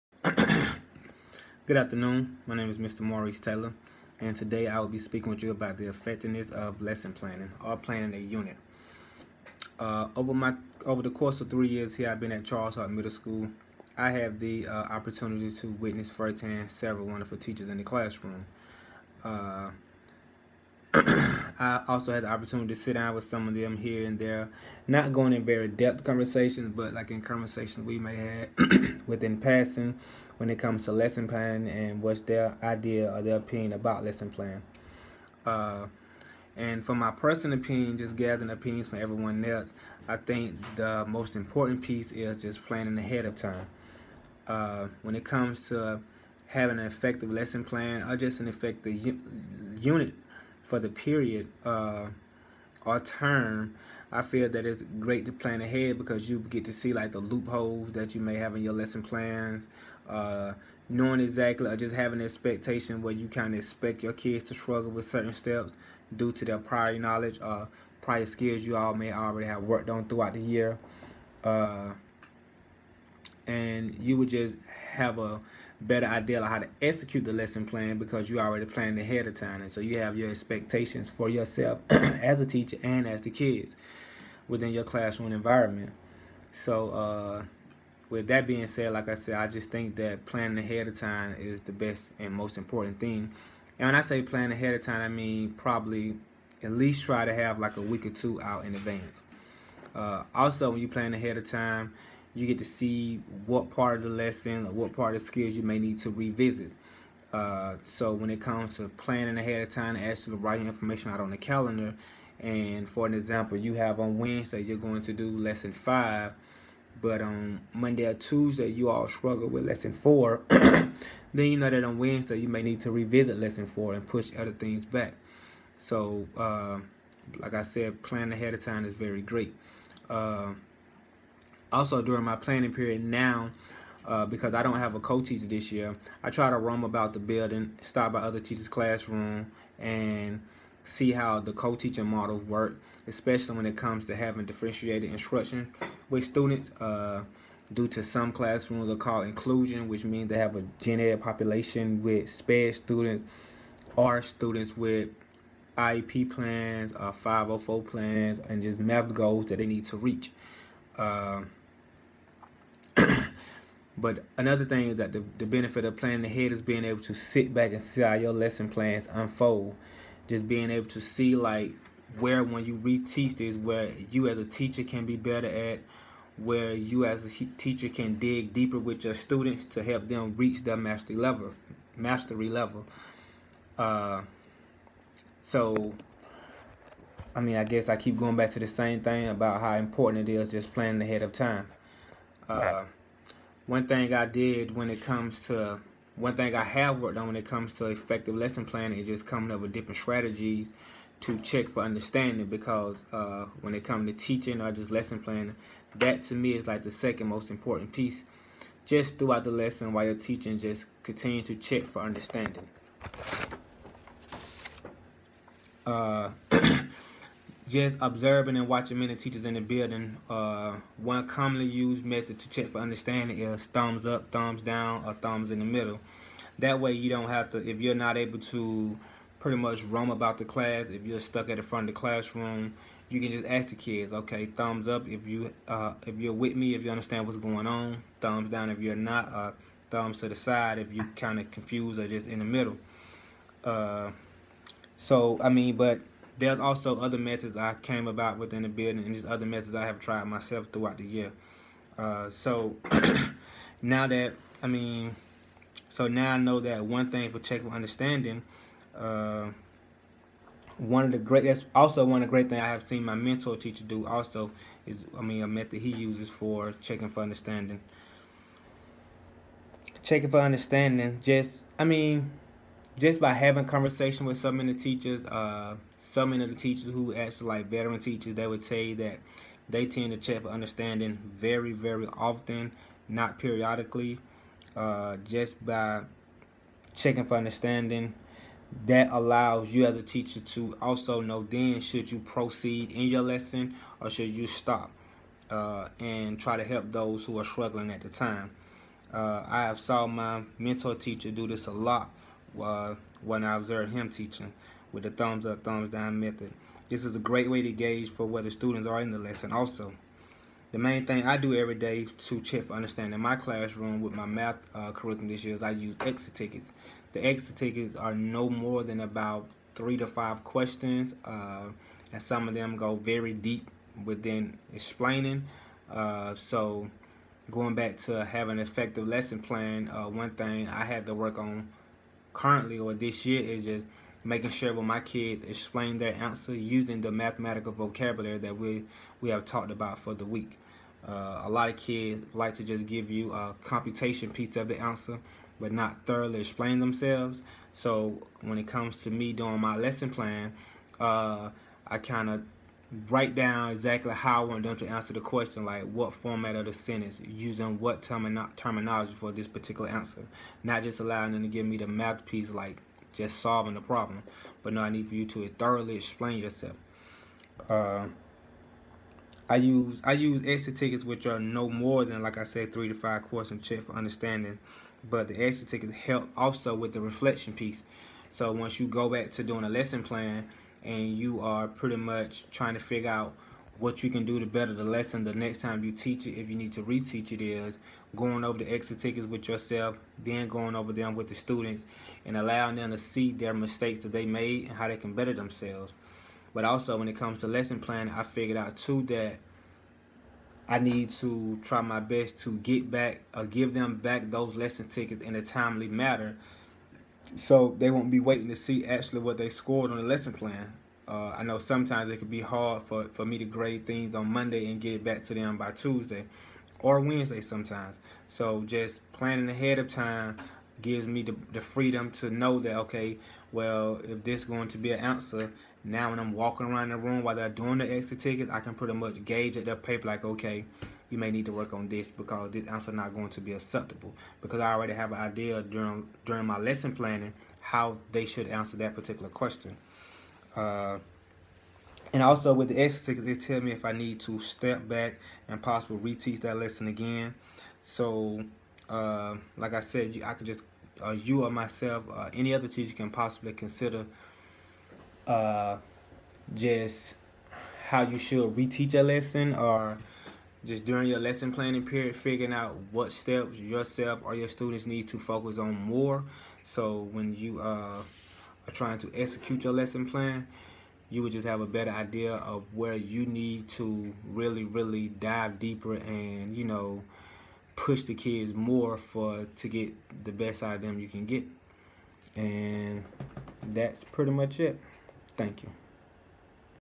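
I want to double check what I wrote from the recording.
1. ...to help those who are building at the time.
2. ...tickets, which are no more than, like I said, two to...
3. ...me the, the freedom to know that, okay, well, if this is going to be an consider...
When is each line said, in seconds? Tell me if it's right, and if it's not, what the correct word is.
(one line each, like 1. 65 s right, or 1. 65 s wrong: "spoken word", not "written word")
1. 296 s wrong: "struggling", not "building"
2. 370 s wrong: "three", not "two"
3. 421 s wrong: "answer", not "consider".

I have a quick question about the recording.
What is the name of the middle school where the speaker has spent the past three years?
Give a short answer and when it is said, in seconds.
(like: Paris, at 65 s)
Charles Hart Middle School, at 12 s.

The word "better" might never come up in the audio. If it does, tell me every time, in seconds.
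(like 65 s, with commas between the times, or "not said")
75 s, 175 s, 384 s, 395 s, 471 s.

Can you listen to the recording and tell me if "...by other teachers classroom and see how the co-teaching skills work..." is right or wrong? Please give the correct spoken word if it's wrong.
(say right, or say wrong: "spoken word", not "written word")
wrong: "models", not "skills".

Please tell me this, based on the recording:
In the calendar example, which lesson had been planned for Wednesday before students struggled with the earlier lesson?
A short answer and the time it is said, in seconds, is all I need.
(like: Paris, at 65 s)
lesson five, at 115 s.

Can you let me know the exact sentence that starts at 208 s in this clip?
Just throughout the lesson while you're teaching, just continue to check for understanding.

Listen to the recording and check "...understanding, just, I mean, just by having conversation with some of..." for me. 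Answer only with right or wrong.
right.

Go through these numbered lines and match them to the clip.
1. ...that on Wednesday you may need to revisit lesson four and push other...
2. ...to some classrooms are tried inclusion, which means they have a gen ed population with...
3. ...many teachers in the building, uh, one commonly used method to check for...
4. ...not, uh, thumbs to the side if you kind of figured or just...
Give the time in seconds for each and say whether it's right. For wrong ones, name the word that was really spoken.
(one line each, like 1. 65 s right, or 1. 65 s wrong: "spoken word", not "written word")
1. 121 s right
2. 147 s wrong: "called", not "tried"
3. 218 s right
4. 238 s wrong: "confused", not "figured".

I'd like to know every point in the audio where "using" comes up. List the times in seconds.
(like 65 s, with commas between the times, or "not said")
336 s, 357 s.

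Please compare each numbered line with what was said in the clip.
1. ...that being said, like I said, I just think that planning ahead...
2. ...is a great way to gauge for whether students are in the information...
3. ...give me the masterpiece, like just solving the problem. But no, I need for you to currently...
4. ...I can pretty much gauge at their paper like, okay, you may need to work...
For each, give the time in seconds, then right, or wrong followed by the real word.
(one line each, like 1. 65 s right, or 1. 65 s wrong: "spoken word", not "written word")
1. 88 s right
2. 307 s wrong: "lesson", not "information"
3. 361 s wrong: "thoroughly", not "currently"
4. 428 s right.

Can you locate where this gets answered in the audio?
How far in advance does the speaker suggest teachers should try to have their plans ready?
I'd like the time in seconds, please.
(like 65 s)
97 s.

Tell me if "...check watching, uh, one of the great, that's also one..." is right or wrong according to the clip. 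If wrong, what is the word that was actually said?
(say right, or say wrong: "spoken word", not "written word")
wrong: "understanding", not "watching".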